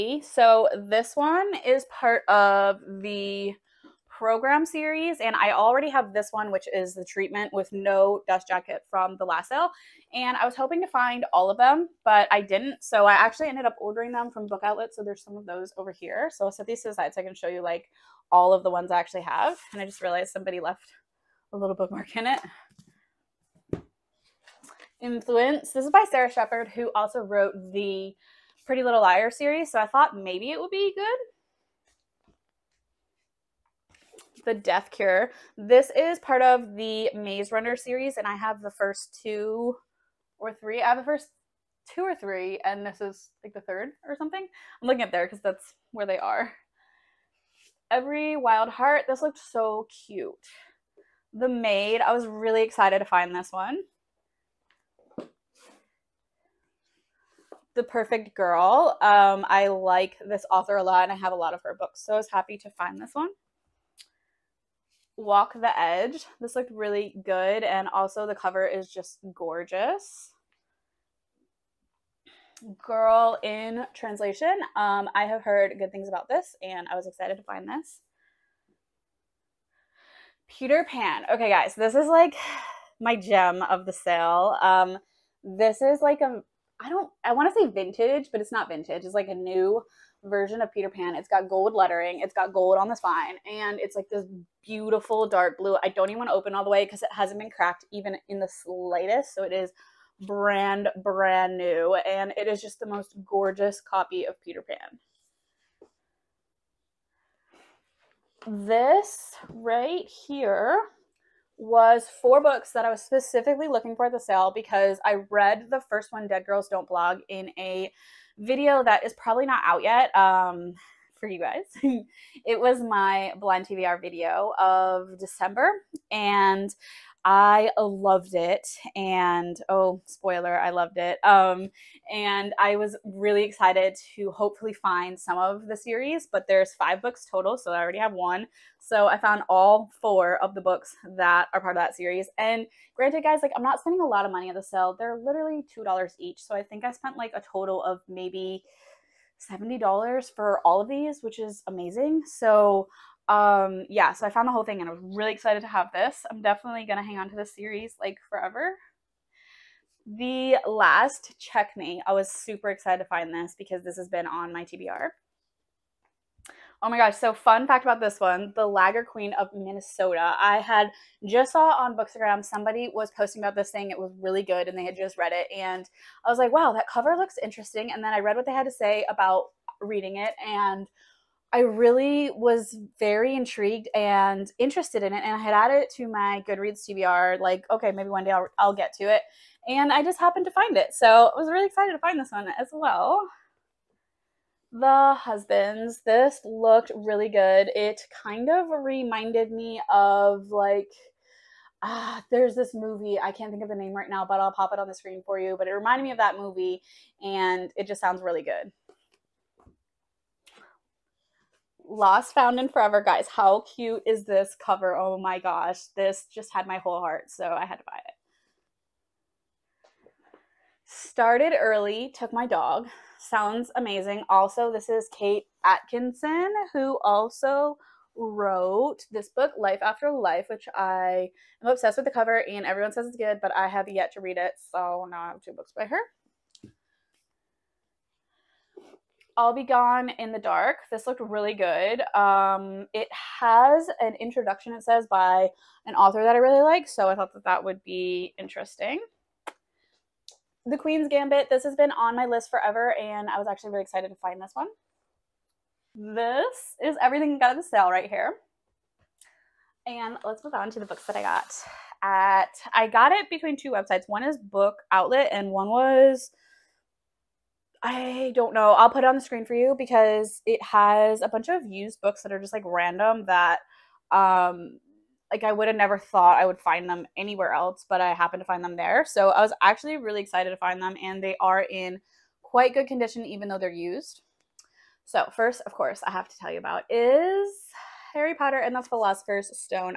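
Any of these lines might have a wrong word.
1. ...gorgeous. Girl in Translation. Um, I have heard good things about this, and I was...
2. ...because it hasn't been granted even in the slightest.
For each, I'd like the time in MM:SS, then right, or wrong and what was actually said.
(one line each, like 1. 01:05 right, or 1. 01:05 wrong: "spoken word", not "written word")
1. 01:09 right
2. 01:36 wrong: "cracked", not "granted".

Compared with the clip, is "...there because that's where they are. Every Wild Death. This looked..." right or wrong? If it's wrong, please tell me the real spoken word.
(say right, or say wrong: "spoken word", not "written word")
wrong: "Heart", not "Death".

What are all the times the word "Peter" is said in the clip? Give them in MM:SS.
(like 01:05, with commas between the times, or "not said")
01:20, 01:30, 01:44.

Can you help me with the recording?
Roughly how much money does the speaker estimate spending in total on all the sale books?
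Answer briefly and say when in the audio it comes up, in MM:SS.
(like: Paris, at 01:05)
$70, at 02:29.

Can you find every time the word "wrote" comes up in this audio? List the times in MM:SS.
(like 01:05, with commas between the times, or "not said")
00:27, 03:48.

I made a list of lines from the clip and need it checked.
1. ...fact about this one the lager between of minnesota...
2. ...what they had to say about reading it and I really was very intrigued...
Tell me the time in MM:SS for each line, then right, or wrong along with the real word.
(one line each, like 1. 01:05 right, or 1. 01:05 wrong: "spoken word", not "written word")
1. 02:47 wrong: "queen", not "between"
2. 02:58 right.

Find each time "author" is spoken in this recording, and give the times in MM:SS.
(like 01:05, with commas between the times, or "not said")
01:00, 04:05.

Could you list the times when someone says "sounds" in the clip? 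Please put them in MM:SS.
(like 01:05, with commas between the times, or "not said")
03:28, 03:43.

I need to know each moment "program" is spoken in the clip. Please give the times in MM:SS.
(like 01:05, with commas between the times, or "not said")
00:04.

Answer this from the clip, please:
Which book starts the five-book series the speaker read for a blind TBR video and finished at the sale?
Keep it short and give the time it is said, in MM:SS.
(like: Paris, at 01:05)
Dead Girls Don't Blog, at 01:56.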